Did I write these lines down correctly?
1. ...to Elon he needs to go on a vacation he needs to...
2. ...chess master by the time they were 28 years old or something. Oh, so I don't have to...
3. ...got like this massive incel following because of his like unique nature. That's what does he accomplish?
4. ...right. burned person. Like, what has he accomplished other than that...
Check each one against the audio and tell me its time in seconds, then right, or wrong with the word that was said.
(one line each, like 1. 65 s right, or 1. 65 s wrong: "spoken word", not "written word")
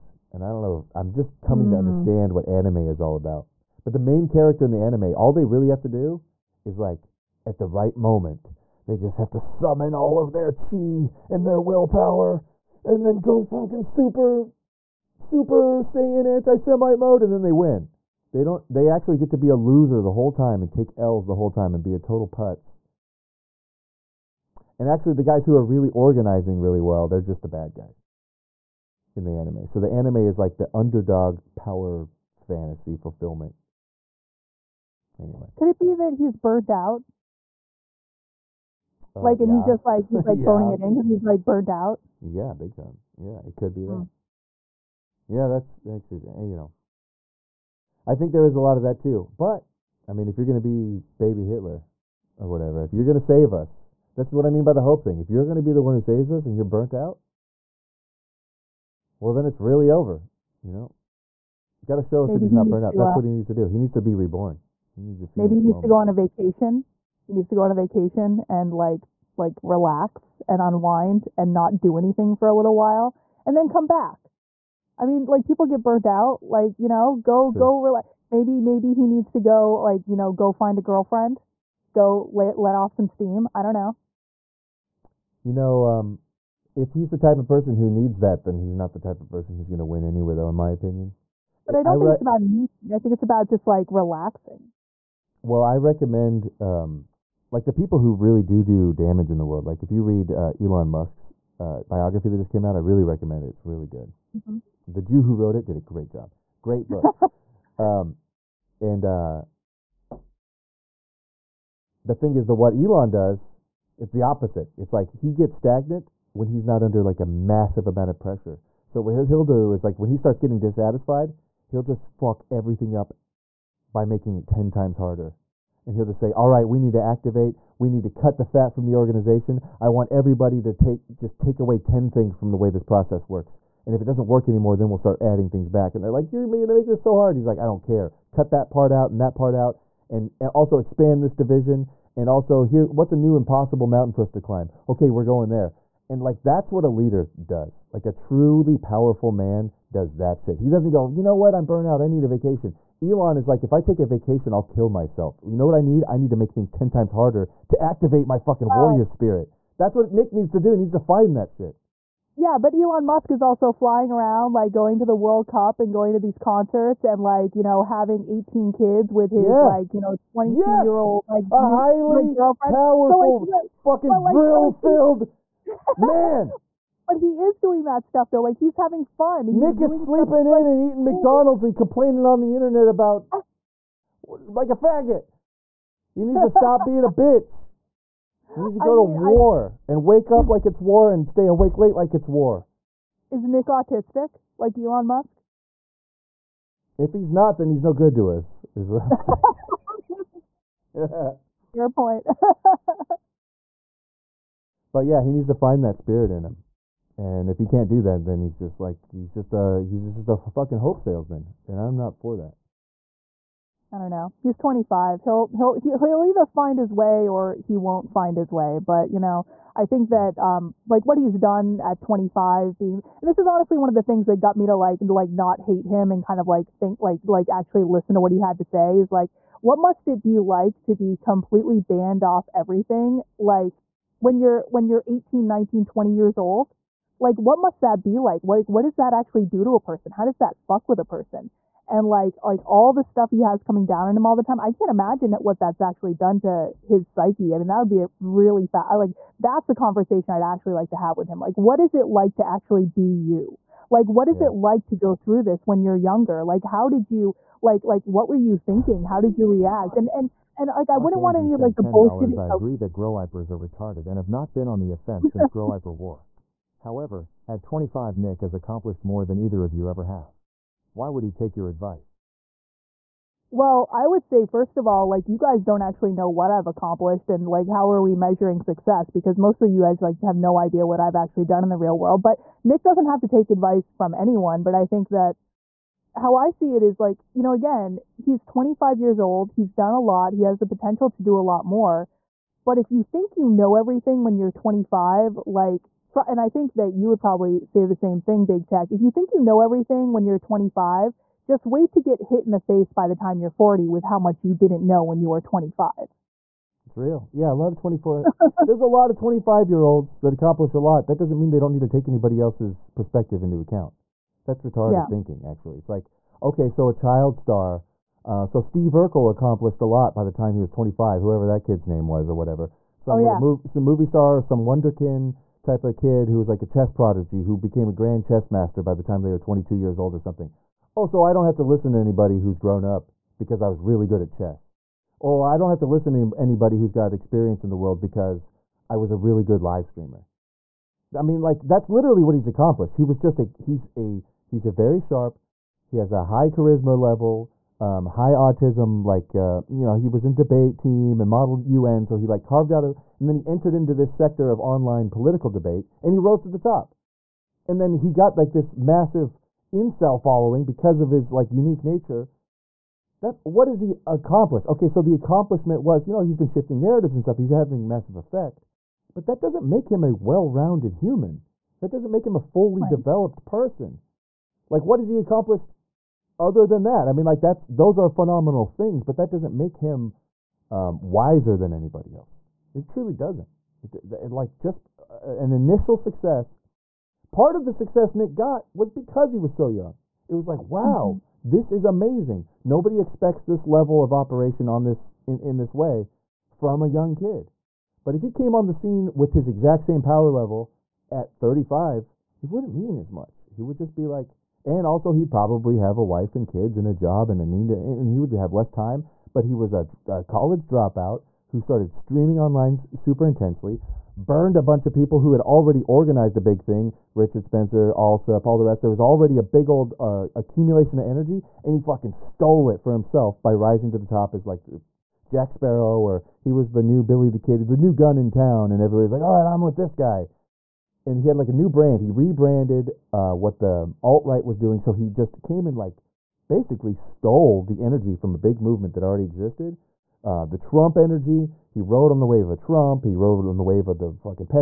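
1. 65 s wrong: "Maybe", not "Elon"
2. 328 s wrong: "22", not "28"
3. 358 s right
4. 372 s wrong: "developed", not "burned".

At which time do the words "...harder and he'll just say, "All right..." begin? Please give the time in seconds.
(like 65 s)
124 s.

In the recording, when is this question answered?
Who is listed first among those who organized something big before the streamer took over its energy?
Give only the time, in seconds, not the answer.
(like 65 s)
417 s.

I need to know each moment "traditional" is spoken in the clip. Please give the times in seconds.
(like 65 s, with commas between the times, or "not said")
not said.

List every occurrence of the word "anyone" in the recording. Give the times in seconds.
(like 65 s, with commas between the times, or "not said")
284 s.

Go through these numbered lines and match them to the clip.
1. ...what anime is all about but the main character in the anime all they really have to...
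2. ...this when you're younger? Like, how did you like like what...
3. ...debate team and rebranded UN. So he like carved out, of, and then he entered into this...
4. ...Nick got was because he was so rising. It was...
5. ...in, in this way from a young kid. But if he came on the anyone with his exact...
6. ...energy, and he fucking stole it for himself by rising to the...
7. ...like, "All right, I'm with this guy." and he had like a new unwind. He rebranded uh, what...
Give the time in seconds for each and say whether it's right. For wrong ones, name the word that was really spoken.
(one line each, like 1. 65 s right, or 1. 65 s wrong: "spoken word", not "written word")
1. 2 s right
2. 255 s right
3. 350 s wrong: "modeled", not "rebranded"
4. 388 s wrong: "young", not "rising"
5. 395 s wrong: "scene", not "anyone"
6. 421 s right
7. 429 s wrong: "brand", not "unwind".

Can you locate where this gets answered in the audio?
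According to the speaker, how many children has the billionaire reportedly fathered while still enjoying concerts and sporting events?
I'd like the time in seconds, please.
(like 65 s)
168 s.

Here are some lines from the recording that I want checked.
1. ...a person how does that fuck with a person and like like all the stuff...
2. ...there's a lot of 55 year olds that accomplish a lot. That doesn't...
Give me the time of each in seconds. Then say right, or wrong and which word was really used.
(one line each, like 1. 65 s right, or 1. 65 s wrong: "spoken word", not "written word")
1. 239 s right
2. 308 s wrong: "25", not "55".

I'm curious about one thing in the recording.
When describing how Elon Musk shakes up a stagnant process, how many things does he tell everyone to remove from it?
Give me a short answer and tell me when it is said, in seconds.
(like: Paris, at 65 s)
10, at 131 s.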